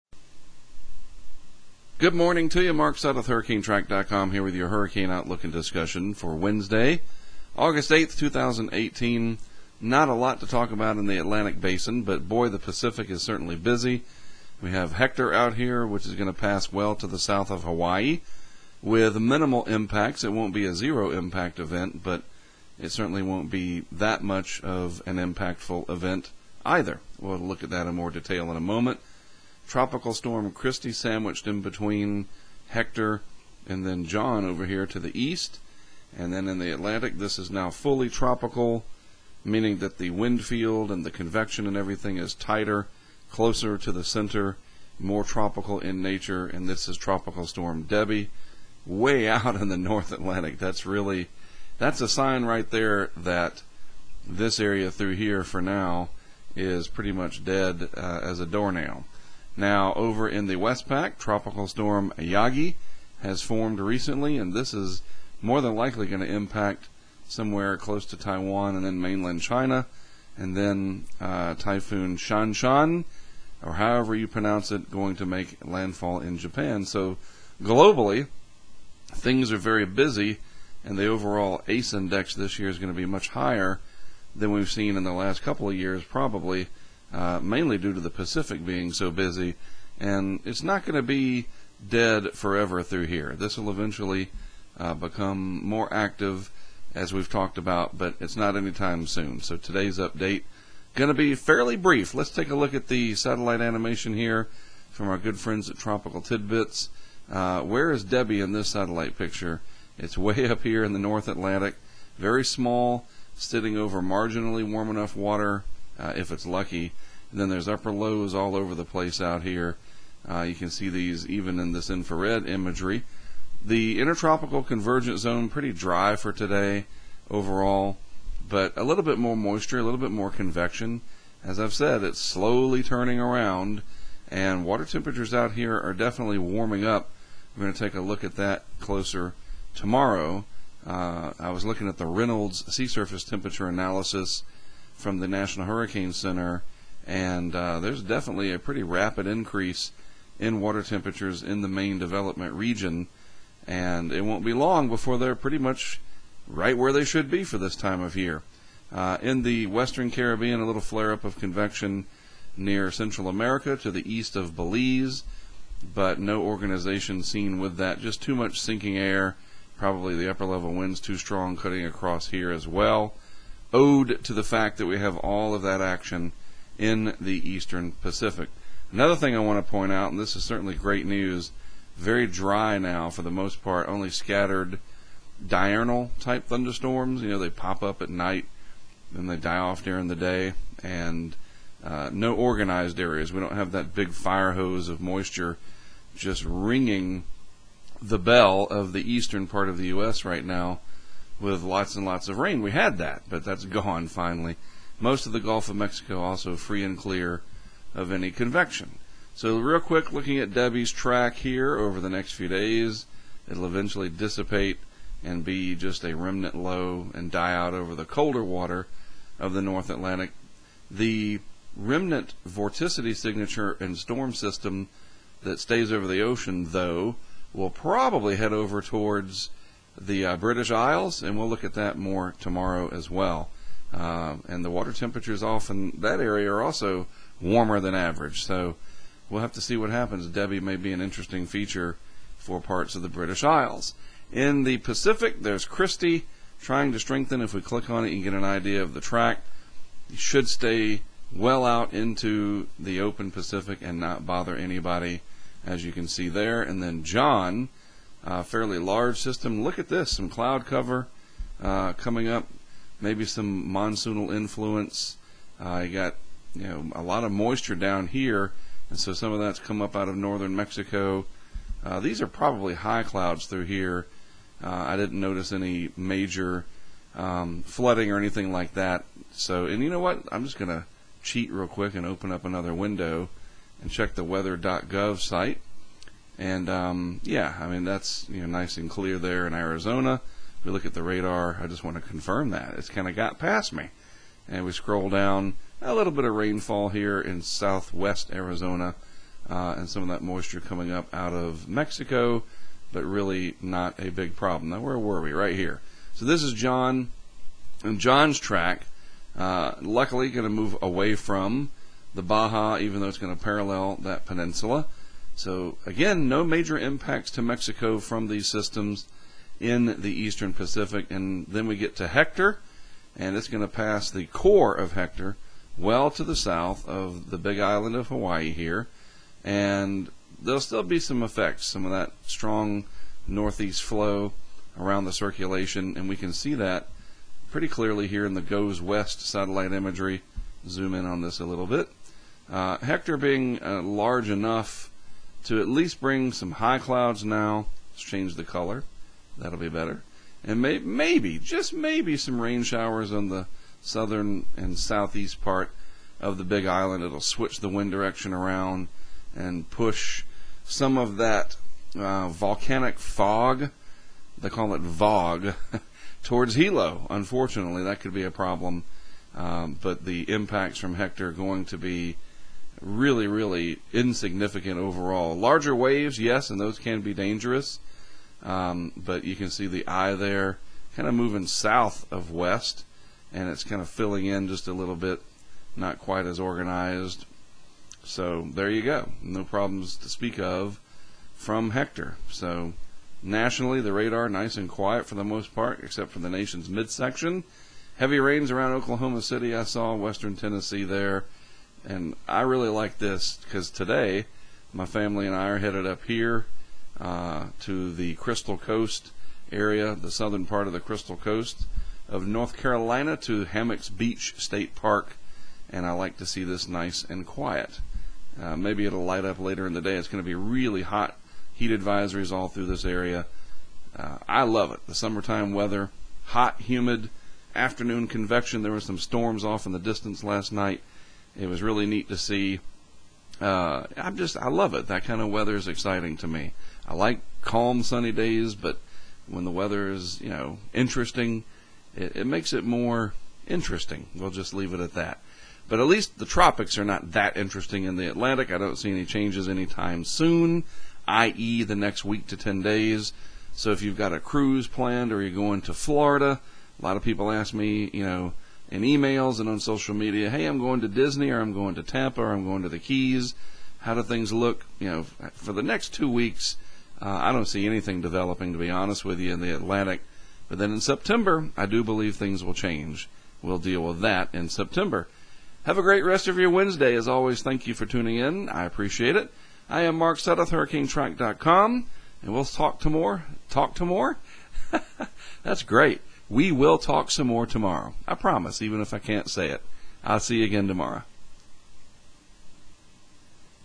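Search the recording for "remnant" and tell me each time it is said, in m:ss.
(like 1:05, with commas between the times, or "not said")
3:36, 3:41.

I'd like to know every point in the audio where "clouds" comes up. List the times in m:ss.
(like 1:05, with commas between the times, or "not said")
4:20, 4:33, 5:46.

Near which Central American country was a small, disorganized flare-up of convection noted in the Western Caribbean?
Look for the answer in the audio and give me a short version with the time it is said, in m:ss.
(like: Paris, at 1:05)
Belize, at 2:44.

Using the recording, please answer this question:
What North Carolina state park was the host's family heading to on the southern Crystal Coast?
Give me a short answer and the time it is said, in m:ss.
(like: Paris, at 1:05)
Hammocks Beach State Park, at 6:53.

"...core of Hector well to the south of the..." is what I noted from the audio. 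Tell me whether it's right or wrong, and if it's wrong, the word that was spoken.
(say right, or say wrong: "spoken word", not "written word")
right.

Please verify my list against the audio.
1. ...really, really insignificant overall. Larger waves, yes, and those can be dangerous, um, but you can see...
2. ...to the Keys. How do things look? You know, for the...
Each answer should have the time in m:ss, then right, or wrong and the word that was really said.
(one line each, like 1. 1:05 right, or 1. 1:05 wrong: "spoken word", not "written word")
1. 6:12 right
2. 7:42 right.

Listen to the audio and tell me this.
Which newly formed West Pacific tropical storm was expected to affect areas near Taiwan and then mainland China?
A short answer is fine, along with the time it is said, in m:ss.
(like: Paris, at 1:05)
Yagi, at 1:02.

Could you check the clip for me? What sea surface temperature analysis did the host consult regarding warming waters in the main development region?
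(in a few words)
Reynolds.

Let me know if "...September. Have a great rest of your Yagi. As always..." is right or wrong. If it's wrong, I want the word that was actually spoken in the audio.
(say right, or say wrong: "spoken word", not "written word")
wrong: "Wednesday", not "Yagi".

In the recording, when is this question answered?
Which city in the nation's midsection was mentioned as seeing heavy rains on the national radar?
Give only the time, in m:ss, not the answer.
6:38.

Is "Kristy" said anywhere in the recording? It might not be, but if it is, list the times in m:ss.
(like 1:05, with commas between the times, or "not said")
0:30, 4:05.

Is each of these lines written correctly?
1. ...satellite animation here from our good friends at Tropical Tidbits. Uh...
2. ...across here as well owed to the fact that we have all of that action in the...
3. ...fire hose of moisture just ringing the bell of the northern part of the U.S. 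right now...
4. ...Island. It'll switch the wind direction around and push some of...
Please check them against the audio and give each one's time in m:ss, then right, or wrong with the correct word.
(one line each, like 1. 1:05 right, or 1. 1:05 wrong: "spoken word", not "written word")
1. 1:43 right
2. 2:51 right
3. 3:14 wrong: "eastern", not "northern"
4. 5:56 right.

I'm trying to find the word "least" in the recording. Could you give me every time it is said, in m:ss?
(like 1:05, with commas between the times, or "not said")
5:45, 7:25.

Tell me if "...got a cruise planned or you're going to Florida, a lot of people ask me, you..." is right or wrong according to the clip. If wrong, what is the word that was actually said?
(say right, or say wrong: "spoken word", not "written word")
right.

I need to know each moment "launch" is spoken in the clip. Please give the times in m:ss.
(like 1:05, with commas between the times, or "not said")
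not said.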